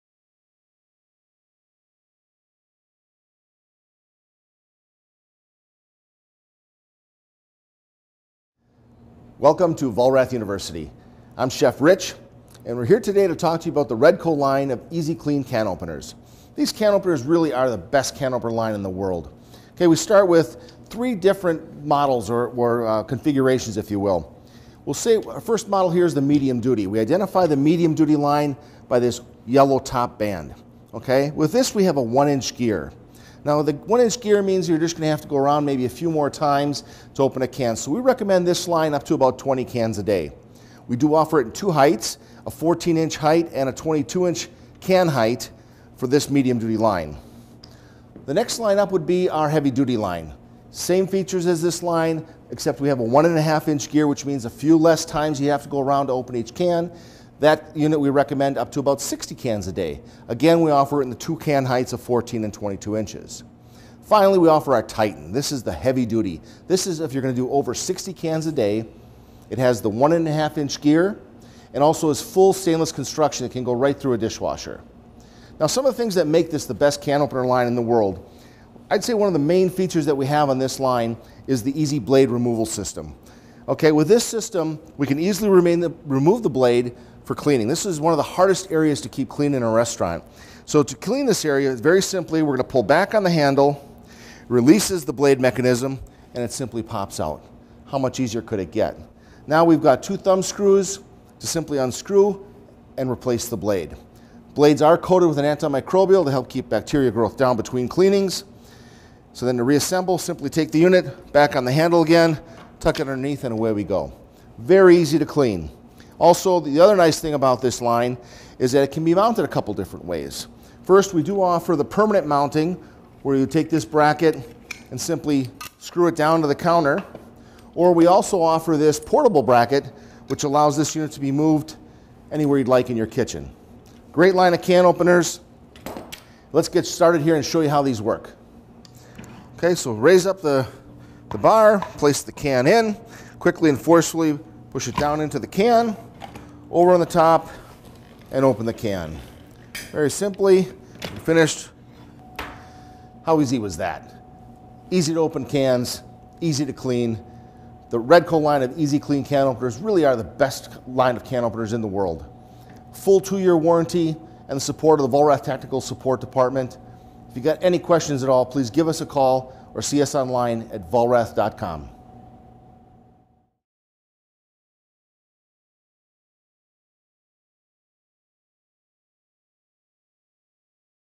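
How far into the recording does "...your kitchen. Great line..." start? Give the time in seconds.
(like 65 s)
132 s.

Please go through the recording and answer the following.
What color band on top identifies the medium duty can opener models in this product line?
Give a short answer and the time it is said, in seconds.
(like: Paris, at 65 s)
Yellow, at 29 s.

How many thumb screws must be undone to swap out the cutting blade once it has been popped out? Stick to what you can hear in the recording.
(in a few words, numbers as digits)
2.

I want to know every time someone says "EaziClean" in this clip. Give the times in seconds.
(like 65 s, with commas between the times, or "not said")
14 s, 158 s.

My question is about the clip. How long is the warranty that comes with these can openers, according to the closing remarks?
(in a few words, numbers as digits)
2 years.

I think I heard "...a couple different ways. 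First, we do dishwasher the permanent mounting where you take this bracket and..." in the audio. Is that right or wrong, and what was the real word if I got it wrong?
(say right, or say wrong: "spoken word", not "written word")
wrong: "offer", not "dishwasher".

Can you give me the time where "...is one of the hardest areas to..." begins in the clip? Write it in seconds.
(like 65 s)
87 s.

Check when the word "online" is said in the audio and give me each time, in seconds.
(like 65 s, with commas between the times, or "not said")
170 s.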